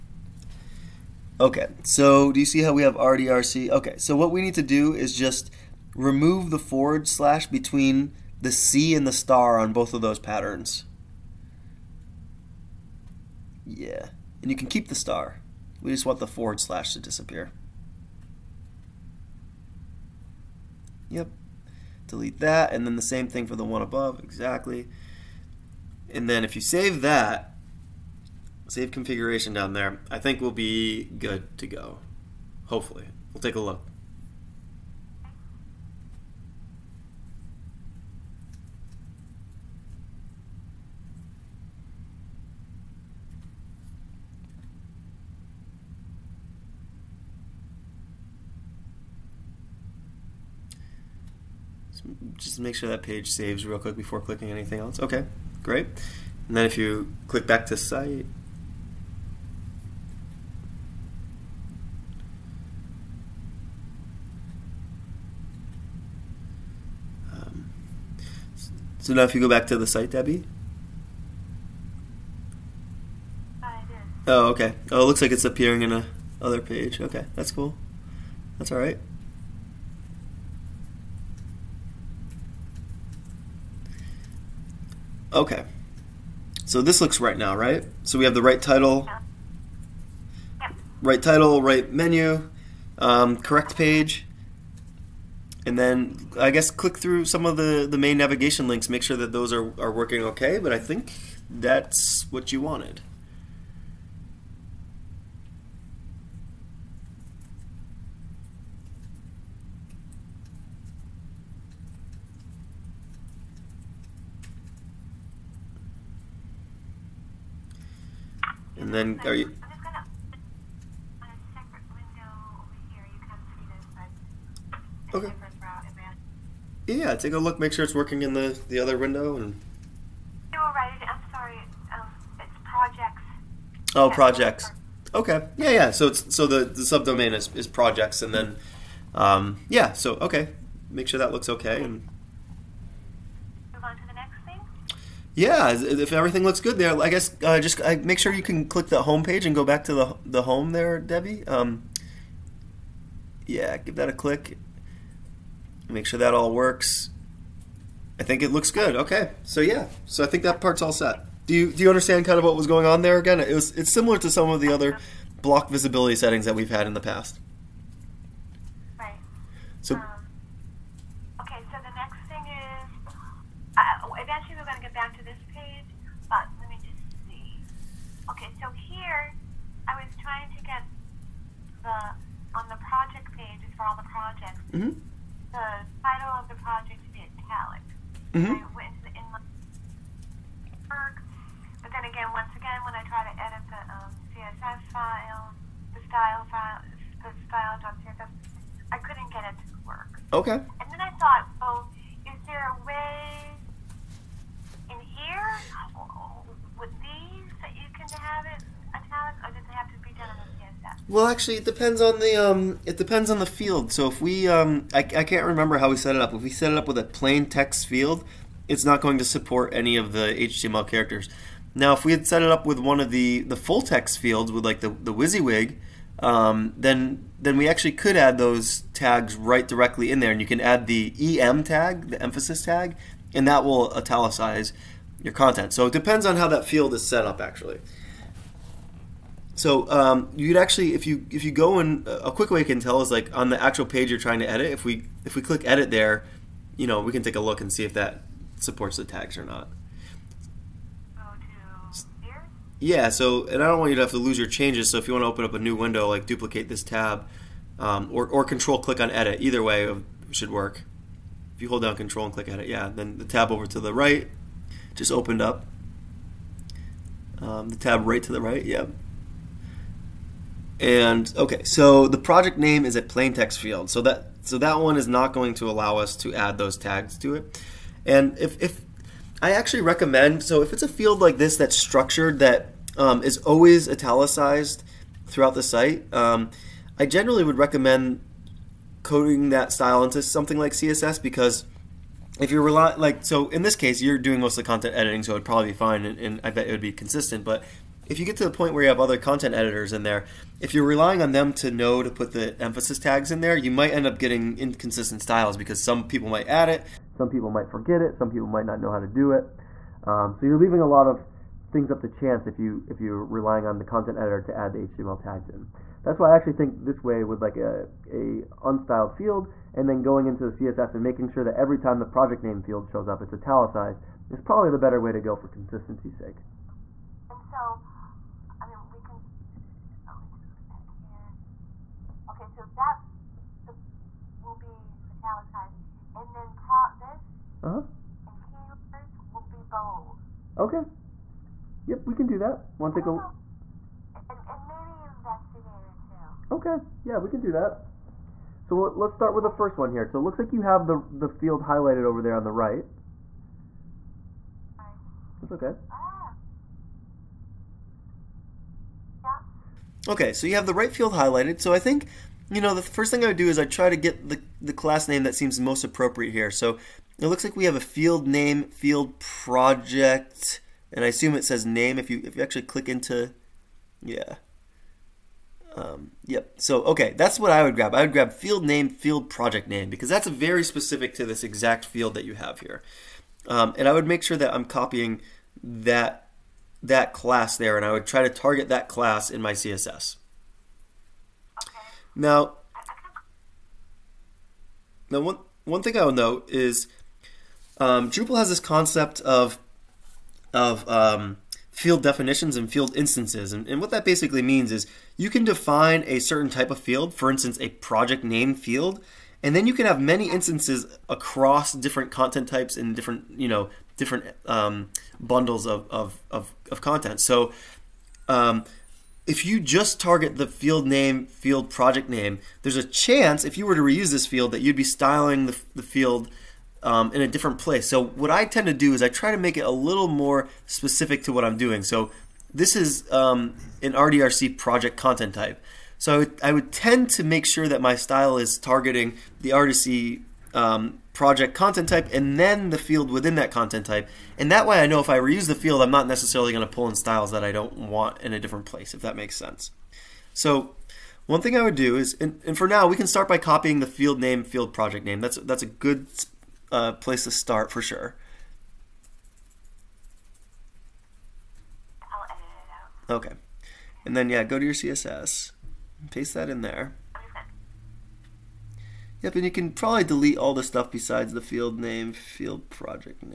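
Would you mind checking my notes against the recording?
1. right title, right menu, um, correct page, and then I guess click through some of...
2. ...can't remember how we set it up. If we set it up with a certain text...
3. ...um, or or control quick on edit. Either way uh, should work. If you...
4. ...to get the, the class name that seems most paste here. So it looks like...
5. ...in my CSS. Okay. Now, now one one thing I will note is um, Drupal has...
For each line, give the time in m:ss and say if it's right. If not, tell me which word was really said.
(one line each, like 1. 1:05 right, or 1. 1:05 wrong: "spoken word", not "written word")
1. 1:31 right
2. 3:35 wrong: "plain", not "certain"
3. 4:17 wrong: "click", not "quick"
4. 6:03 wrong: "appropriate", not "paste"
5. 6:29 right.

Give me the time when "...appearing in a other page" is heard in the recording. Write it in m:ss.
1:15.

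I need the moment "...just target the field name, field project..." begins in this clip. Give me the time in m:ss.
6:59.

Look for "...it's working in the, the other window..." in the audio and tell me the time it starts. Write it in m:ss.
2:07.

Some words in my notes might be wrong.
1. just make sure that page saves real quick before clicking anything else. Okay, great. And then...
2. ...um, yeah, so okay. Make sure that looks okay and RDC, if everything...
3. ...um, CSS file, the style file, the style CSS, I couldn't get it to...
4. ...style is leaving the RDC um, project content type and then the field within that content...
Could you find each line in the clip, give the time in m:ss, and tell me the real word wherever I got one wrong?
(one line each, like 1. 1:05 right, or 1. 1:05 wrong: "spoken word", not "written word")
1. 0:52 right
2. 2:19 wrong: "Yeah", not "RDC"
3. 3:13 right
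4. 7:17 wrong: "targeting", not "leaving".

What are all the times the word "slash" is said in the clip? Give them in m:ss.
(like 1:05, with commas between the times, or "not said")
0:07, 0:16.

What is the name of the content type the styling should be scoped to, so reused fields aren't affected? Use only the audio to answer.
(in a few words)
RDRC project.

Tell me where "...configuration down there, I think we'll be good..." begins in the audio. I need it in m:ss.
0:28.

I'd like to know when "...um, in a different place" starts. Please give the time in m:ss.
7:06.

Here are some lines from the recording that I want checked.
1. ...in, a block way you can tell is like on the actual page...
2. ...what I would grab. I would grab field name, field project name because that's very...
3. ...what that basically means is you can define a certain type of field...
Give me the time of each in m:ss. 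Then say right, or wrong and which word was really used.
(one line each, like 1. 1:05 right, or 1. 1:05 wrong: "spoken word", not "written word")
1. 4:01 wrong: "quick", not "block"
2. 6:17 right
3. 6:43 right.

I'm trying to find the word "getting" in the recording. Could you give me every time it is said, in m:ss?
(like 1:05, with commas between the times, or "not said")
5:04.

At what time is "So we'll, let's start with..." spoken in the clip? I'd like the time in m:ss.
5:48.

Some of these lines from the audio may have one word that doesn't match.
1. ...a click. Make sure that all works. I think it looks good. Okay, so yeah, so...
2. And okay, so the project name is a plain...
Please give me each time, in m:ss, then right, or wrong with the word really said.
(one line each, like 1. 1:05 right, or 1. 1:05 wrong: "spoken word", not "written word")
1. 2:34 right
2. 4:30 right.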